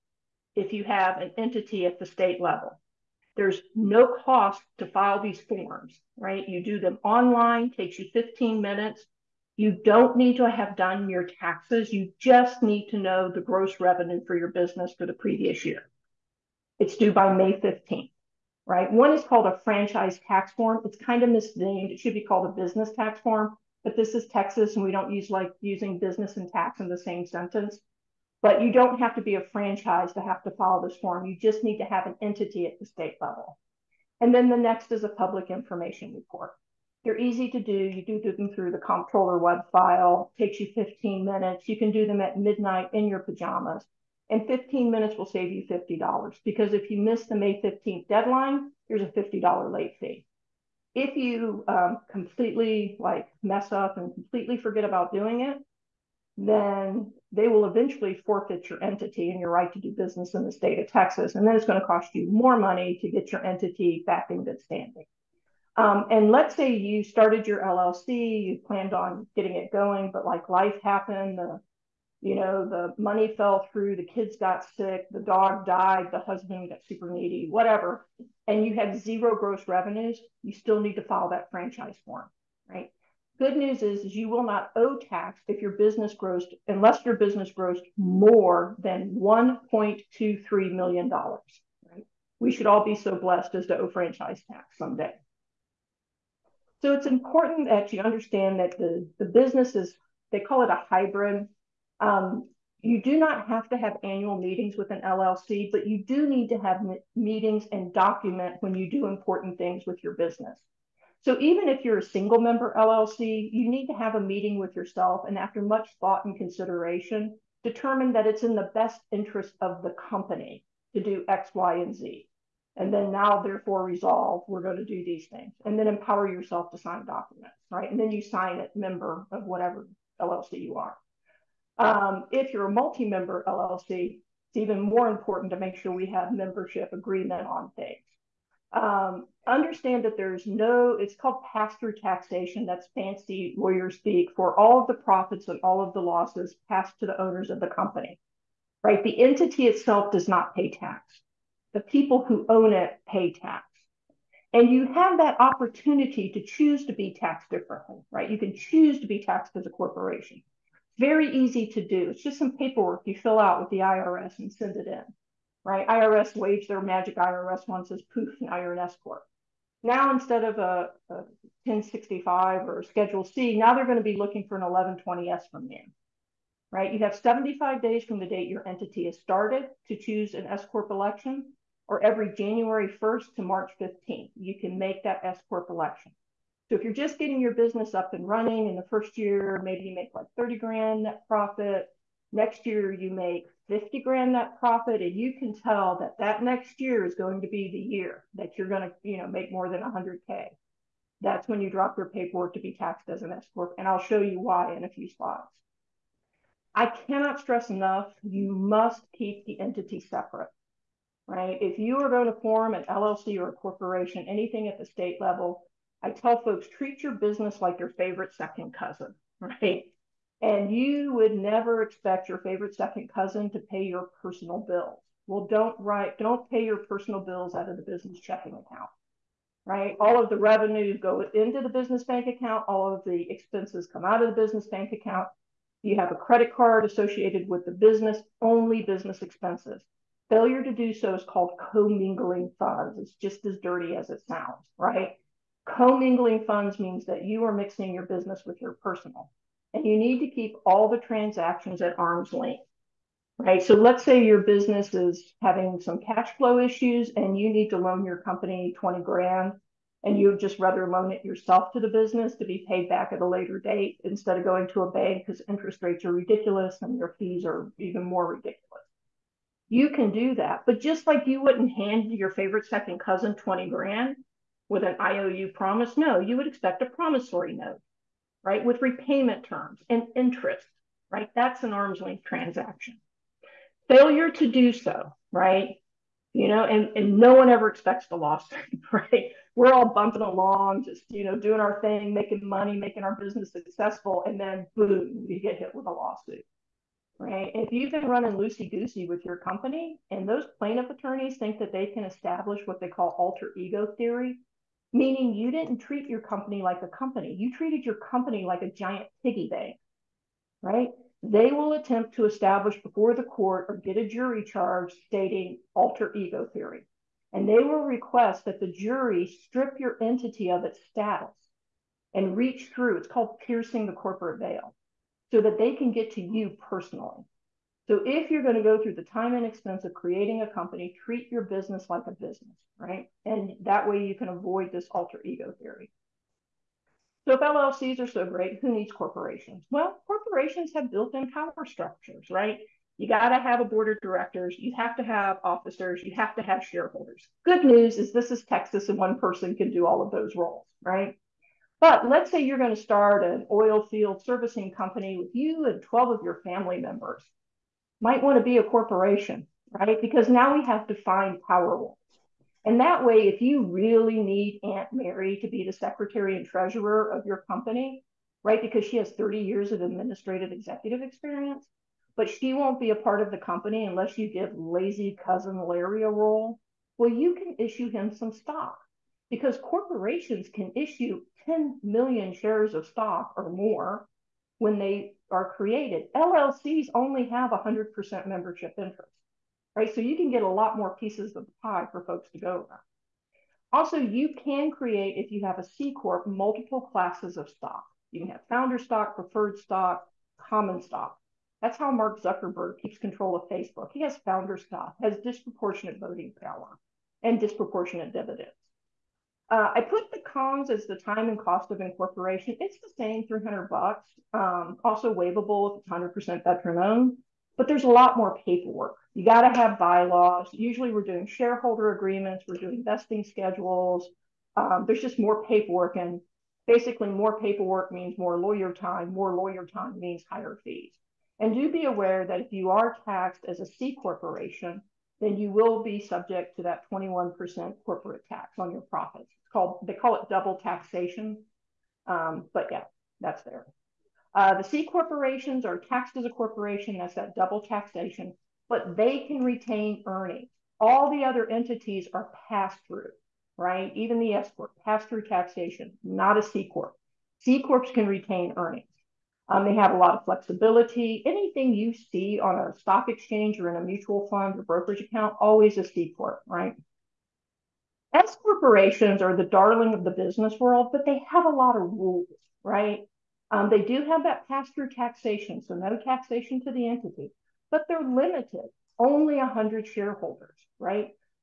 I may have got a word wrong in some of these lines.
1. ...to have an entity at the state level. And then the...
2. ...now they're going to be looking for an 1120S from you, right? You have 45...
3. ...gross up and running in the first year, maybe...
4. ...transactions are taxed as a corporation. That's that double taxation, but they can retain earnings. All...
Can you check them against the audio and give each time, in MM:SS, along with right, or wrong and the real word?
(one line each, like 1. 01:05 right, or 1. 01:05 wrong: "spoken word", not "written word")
1. 00:31 right
2. 02:53 wrong: "75", not "45"
3. 03:07 wrong: "business", not "gross"
4. 07:24 wrong: "corporations", not "transactions".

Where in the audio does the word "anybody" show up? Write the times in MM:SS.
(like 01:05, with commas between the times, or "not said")
not said.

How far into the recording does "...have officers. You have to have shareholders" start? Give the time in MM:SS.
05:45.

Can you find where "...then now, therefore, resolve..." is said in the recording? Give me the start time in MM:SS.
02:02.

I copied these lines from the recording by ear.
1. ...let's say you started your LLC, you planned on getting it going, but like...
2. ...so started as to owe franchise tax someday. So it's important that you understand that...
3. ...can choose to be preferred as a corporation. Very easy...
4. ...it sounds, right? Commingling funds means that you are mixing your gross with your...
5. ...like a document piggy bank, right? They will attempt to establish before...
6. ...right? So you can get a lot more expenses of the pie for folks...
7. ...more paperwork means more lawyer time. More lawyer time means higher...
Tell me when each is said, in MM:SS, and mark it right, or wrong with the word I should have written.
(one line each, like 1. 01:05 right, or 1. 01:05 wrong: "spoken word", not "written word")
1. 01:06 right
2. 01:32 wrong: "blessed", not "started"
3. 02:38 wrong: "taxed", not "preferred"
4. 04:04 wrong: "business", not "gross"
5. 05:08 wrong: "giant", not "document"
6. 06:29 wrong: "pieces", not "expenses"
7. 07:07 right.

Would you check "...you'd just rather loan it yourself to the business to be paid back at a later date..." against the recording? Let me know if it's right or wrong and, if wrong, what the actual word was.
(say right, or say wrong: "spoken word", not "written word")
right.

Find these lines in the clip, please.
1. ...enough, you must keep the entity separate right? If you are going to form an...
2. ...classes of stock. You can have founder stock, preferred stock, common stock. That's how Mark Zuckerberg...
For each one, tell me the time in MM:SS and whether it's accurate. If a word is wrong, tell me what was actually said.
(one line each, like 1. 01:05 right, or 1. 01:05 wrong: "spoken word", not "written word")
1. 03:27 right
2. 06:36 right.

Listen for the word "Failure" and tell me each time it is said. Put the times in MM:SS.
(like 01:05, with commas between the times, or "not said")
04:00, 04:43.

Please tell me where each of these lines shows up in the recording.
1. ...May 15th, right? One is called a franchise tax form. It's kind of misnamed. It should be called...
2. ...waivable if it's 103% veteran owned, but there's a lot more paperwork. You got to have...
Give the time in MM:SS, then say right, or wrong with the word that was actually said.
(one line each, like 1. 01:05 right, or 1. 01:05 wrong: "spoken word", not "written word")
1. 00:17 right
2. 06:55 wrong: "100", not "103".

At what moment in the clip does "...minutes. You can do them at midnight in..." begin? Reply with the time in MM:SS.
00:41.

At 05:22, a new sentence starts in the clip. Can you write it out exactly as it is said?
It's called piercing the corporate veil so that they can get to you personally.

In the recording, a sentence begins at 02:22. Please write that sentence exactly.
That's fancy lawyer speak for all of the profits and all of the losses passed to the owners of the company, right?